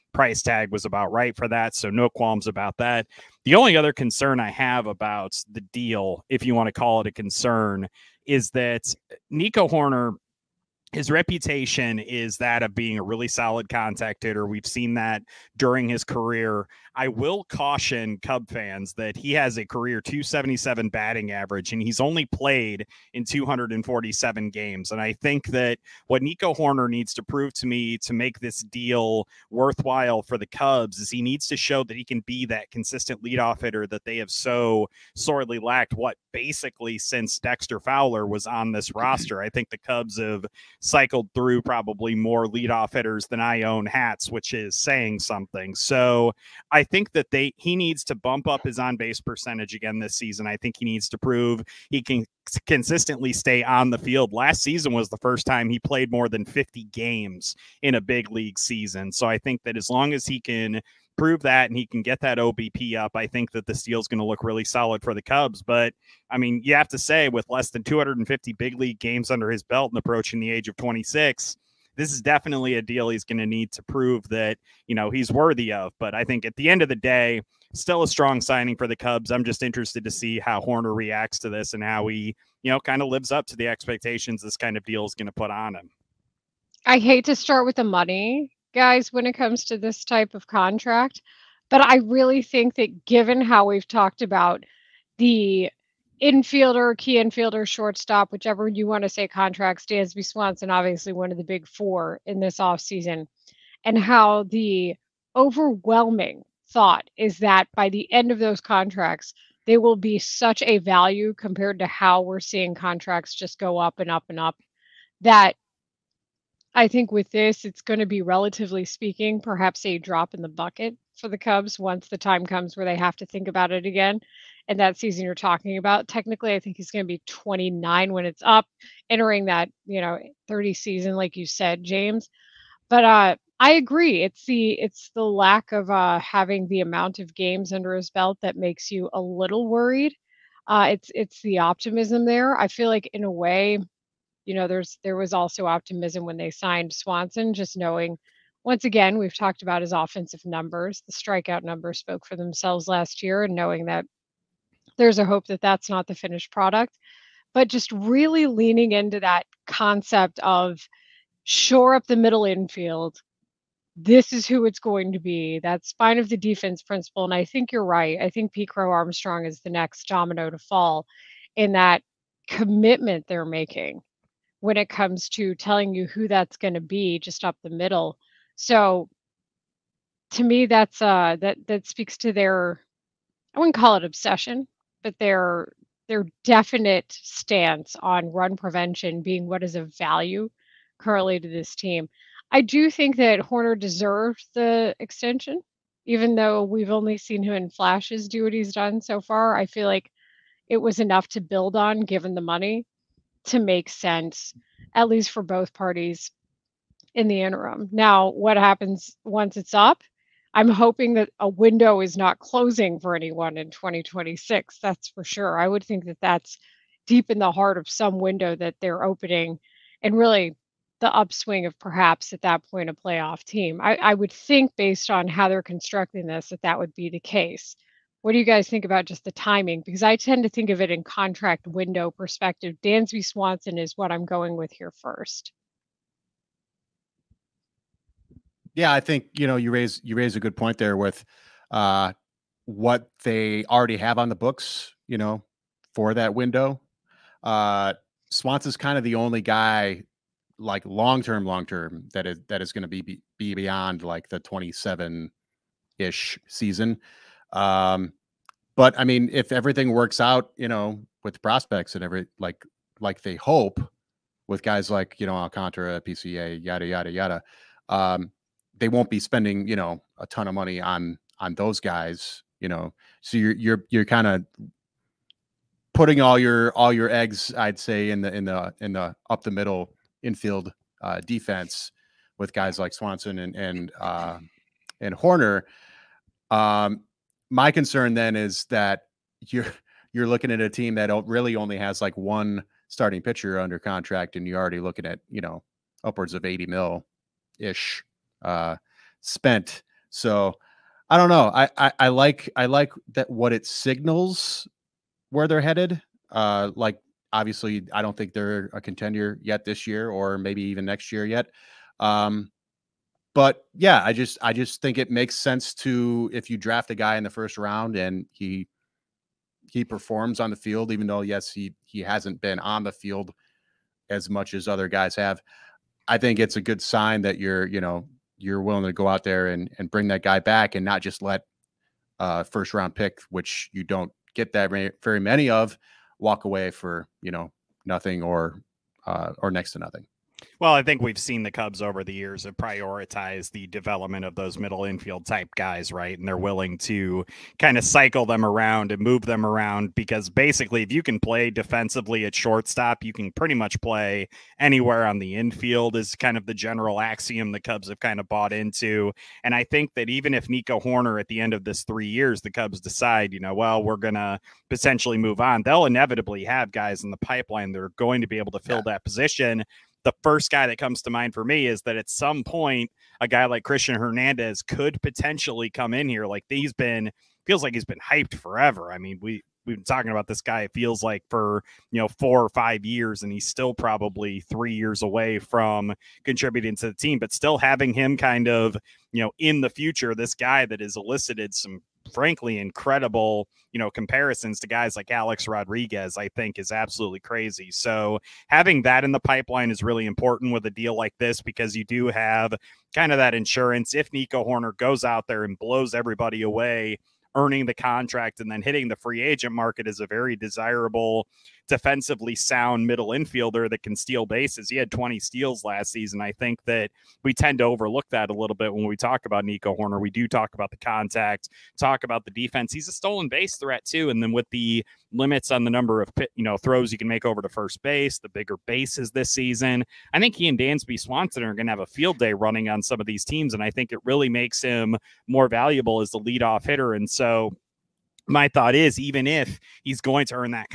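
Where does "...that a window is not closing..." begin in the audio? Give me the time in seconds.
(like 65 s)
211 s.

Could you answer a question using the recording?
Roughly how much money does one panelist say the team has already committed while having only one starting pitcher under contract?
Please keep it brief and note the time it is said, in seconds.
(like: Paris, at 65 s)
80 million, at 296 s.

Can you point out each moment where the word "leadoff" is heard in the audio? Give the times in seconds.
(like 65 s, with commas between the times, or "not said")
33 s, 42 s, 436 s.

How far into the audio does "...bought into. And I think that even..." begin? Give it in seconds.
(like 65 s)
358 s.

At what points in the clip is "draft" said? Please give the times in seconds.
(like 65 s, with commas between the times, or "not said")
316 s.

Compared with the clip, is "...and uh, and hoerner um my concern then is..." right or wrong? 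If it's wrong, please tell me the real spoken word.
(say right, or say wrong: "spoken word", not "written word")
right.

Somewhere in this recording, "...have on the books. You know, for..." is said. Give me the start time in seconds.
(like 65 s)
243 s.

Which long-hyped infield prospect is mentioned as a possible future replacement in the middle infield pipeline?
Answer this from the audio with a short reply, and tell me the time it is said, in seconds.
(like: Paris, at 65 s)
Cristian Hernandez, at 373 s.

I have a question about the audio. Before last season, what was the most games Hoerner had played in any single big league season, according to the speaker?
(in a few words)
50.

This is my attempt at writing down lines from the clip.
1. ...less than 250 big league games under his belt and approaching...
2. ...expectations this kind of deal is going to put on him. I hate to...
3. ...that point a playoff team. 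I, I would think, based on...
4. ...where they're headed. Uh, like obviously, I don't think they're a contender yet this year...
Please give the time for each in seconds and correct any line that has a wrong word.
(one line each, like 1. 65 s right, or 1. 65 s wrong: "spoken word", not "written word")
1. 67 s right
2. 83 s right
3. 222 s right
4. 305 s right.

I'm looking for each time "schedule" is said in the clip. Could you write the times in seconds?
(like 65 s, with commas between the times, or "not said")
not said.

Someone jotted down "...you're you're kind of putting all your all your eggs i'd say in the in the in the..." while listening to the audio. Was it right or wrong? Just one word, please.
right.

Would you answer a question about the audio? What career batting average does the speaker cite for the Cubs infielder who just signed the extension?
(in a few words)
.277.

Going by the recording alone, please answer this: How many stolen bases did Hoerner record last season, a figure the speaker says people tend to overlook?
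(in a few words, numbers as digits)
20.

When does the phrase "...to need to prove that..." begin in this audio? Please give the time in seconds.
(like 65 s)
73 s.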